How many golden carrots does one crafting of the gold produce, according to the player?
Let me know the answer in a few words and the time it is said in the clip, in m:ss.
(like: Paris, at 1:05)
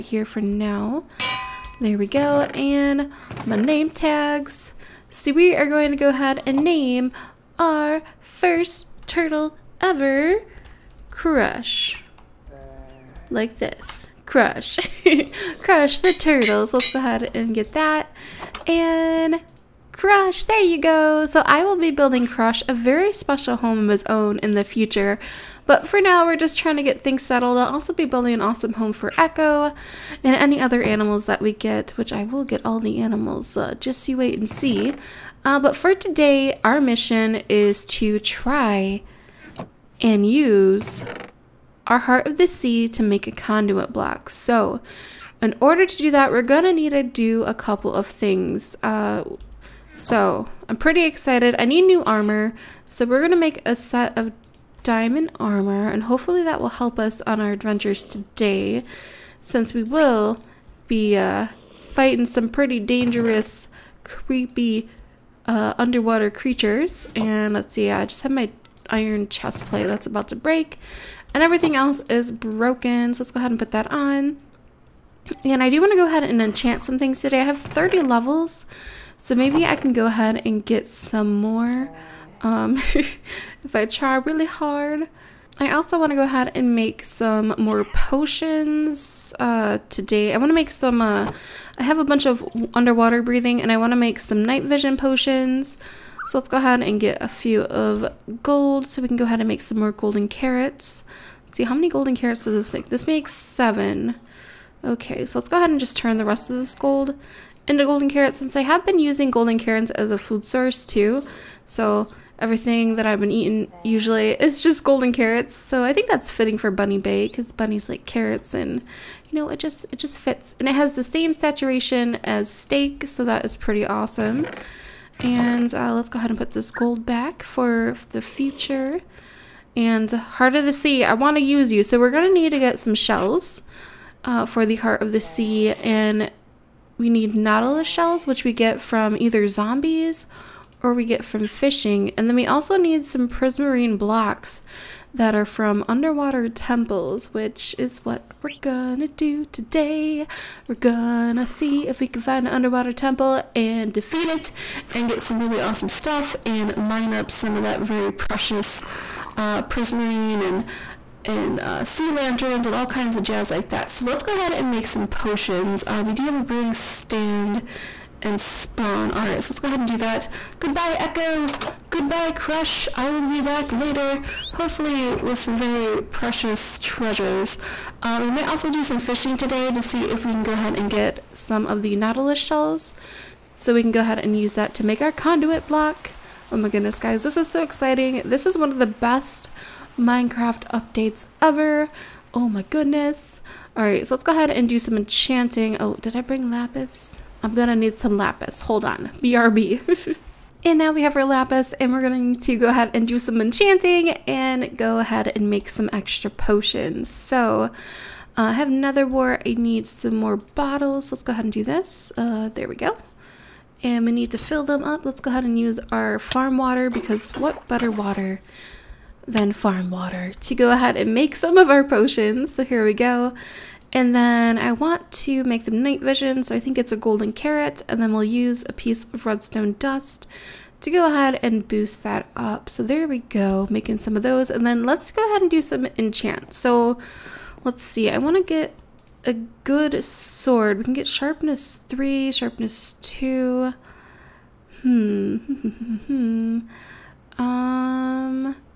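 7, at 1:43.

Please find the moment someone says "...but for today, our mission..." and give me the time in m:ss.
0:35.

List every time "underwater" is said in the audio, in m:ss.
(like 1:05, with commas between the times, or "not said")
1:05, 1:32, 2:25, 2:32.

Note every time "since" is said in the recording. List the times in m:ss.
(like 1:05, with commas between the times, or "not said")
0:59, 1:48.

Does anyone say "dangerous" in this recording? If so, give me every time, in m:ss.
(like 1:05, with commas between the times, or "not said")
1:02.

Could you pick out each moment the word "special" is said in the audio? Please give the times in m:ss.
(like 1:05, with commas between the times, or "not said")
0:23.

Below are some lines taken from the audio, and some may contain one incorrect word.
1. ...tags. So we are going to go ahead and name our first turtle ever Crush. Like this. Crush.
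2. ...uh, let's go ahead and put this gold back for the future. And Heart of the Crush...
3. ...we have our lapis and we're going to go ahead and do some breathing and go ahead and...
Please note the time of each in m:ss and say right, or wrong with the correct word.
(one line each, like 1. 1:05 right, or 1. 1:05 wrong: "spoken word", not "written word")
1. 0:03 right
2. 2:05 wrong: "Sea", not "Crush"
3. 3:20 wrong: "enchanting", not "breathing".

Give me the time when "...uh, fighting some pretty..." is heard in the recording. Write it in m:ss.
1:01.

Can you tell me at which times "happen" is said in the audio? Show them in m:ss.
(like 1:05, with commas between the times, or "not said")
not said.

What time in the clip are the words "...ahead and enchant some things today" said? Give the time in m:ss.
1:16.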